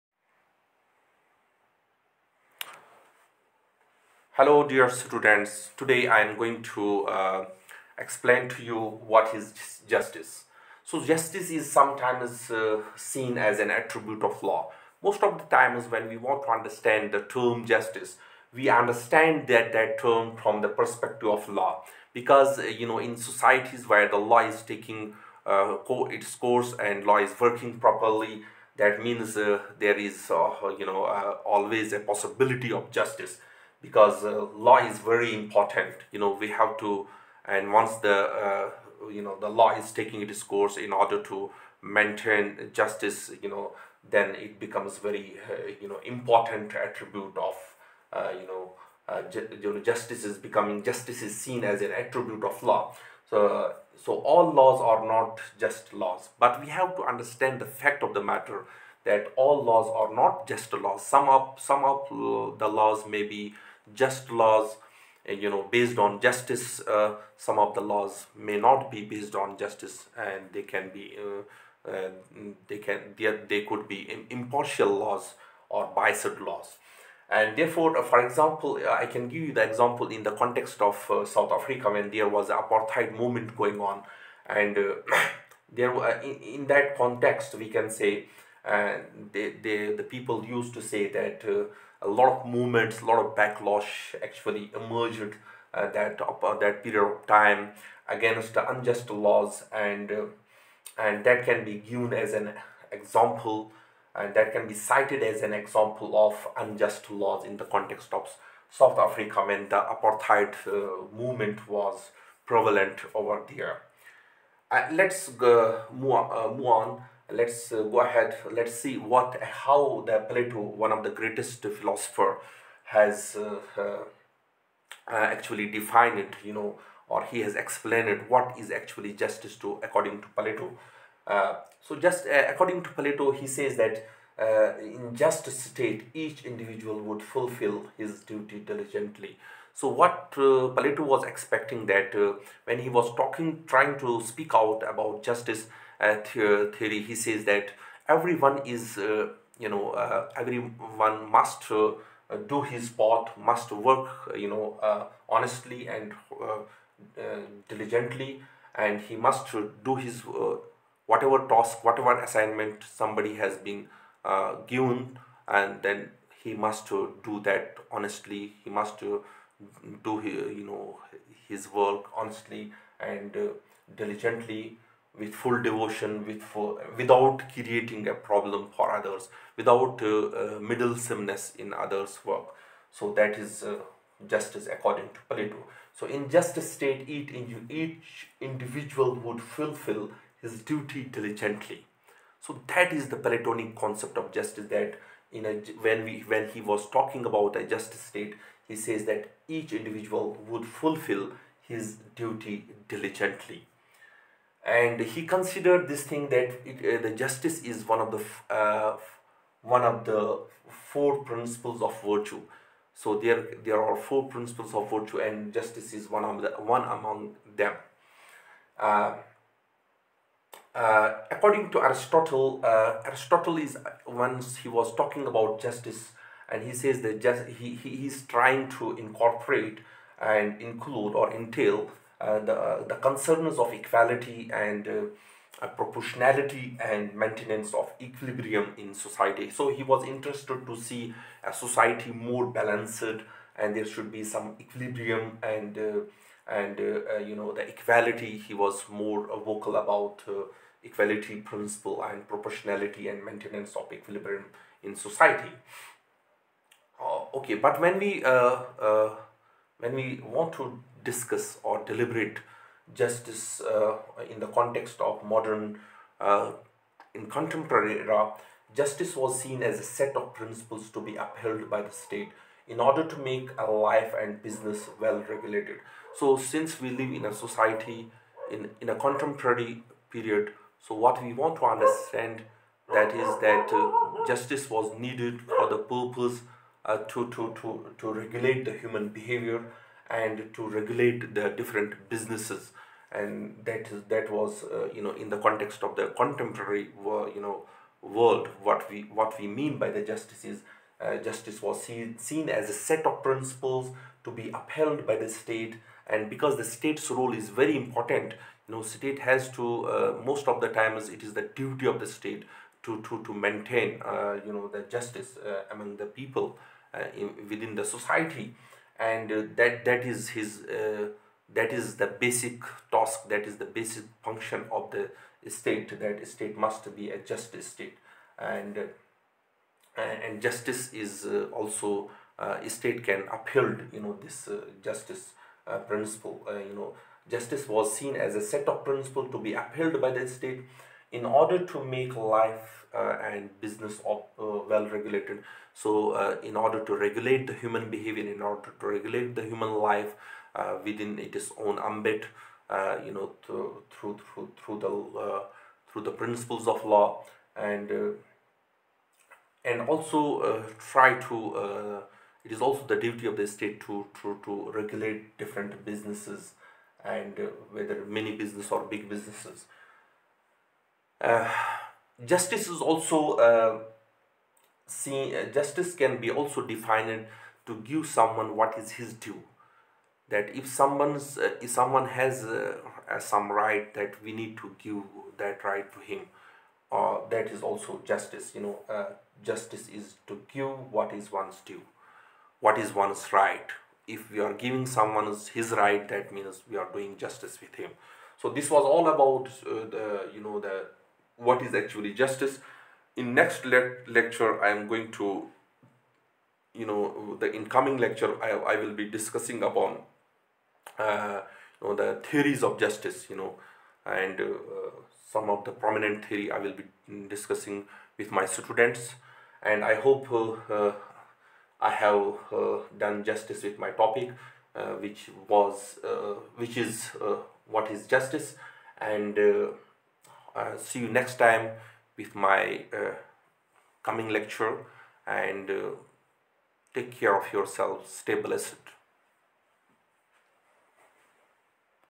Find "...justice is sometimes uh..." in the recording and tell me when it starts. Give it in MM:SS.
00:11.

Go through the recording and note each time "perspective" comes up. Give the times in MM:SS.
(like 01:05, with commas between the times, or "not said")
00:20.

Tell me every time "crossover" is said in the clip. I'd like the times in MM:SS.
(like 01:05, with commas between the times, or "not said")
not said.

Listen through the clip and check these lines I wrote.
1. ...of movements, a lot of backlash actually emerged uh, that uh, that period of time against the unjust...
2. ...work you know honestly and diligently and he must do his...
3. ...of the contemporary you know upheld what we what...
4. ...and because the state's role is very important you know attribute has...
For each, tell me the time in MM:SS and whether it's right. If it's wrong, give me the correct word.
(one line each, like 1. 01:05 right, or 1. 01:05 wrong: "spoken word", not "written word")
1. 01:32 right
2. 02:33 right
3. 04:55 wrong: "world", not "upheld"
4. 05:06 wrong: "state", not "attribute".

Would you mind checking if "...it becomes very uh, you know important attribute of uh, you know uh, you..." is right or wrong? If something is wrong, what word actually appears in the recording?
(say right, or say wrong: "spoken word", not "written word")
right.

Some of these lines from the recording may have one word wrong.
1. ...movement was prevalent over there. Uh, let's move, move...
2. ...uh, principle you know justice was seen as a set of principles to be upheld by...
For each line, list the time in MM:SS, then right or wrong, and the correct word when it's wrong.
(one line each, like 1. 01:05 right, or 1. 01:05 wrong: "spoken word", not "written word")
1. 01:51 right
2. 05:35 right.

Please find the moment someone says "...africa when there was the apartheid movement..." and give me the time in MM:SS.
01:21.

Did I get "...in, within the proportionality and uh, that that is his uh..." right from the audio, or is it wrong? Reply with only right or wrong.
wrong.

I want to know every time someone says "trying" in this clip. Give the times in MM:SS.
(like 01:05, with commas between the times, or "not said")
02:23, 03:48.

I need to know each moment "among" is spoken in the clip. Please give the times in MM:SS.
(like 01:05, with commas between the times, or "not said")
03:36, 05:15.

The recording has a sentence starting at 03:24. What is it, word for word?
And he considered this thing that it, uh, the justice is one of the uh, one of the four principles of virtue.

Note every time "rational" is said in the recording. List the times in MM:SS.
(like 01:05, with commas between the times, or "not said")
not said.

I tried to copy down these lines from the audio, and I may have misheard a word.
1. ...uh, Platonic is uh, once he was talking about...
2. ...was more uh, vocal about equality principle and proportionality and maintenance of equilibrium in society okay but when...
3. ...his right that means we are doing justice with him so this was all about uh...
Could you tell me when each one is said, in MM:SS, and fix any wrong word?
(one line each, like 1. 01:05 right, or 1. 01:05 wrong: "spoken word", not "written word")
1. 03:42 wrong: "Aristotle", not "Platonic"
2. 04:08 right
3. 06:35 right.